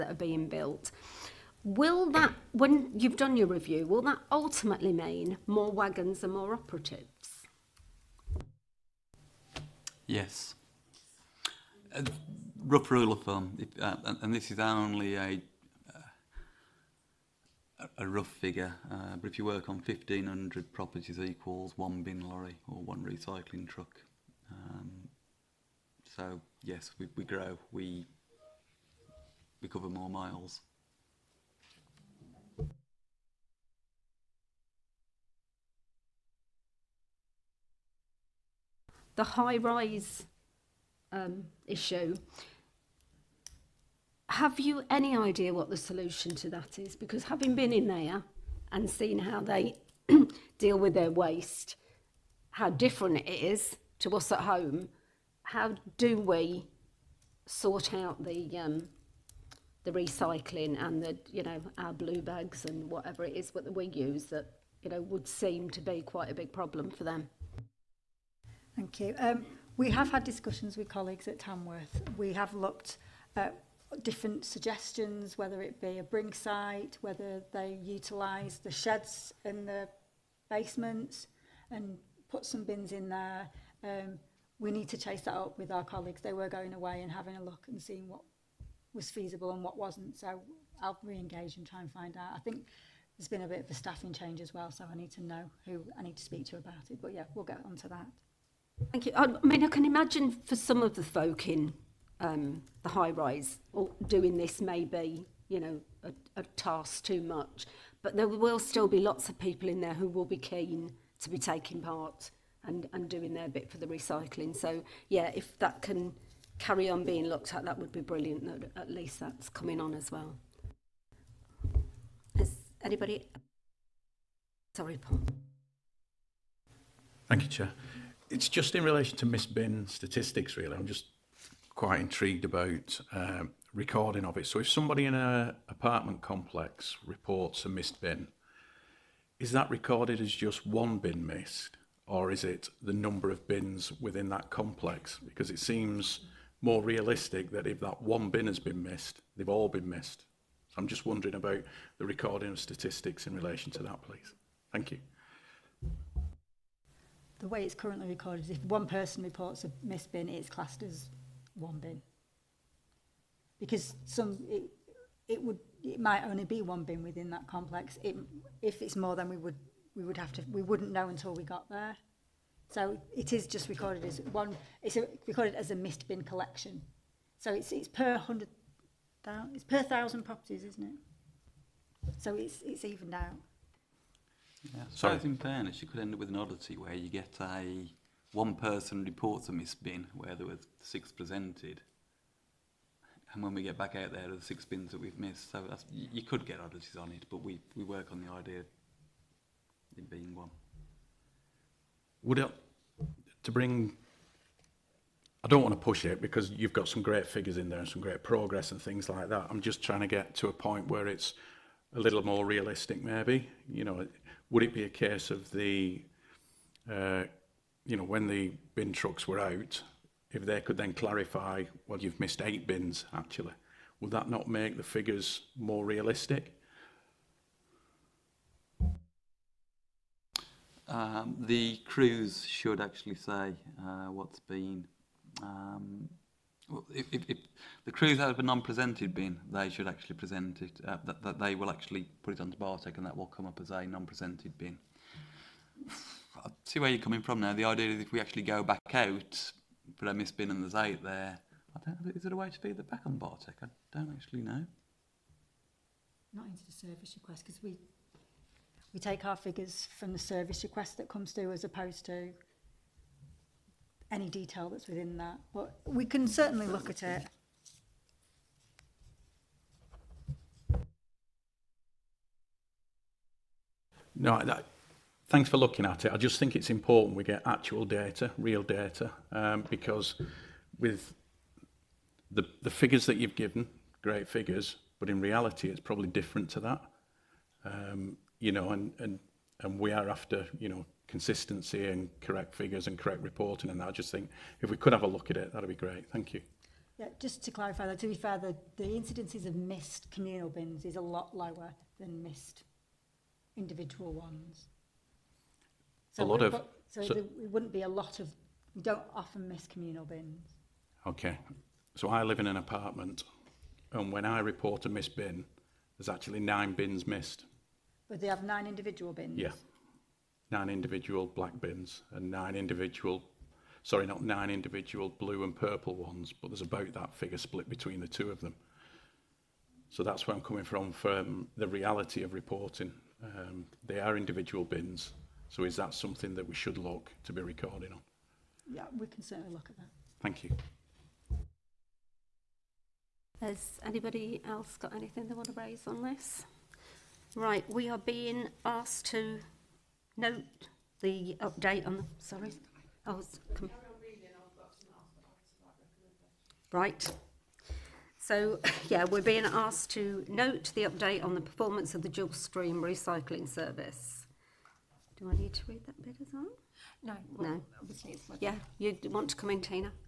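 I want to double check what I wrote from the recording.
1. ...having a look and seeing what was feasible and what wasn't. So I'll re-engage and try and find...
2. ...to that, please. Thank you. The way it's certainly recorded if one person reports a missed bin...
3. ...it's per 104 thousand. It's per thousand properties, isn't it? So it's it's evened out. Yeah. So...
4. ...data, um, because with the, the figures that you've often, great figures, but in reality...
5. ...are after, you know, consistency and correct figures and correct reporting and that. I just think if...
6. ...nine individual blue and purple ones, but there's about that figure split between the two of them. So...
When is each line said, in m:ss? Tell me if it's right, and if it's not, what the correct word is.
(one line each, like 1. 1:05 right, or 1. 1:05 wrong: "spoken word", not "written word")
1. 1:27 right
2. 2:33 wrong: "currently", not "certainly"
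3. 2:57 wrong: "100", not "104"
4. 4:38 wrong: "given", not "often"
5. 4:49 right
6. 5:24 right.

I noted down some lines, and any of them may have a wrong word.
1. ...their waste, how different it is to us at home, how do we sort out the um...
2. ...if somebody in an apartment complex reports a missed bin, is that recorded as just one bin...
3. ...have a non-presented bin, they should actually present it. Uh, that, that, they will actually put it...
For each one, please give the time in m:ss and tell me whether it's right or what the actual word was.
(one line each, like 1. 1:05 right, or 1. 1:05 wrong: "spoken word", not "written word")
1. 0:50 right
2. 2:14 right
3. 3:58 right.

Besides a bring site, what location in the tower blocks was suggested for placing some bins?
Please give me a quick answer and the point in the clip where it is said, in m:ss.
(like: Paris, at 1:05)
the sheds in the basements, at 1:18.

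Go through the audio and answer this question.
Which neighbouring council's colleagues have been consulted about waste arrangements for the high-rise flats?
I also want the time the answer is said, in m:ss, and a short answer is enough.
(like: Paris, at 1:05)
Tamworth, at 1:11.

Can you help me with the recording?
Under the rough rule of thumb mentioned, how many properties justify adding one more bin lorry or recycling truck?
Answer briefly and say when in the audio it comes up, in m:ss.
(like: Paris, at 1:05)
1,500, at 0:19.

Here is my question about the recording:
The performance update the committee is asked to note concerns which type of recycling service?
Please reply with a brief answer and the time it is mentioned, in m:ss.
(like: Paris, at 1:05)
dual stream recycling service, at 6:02.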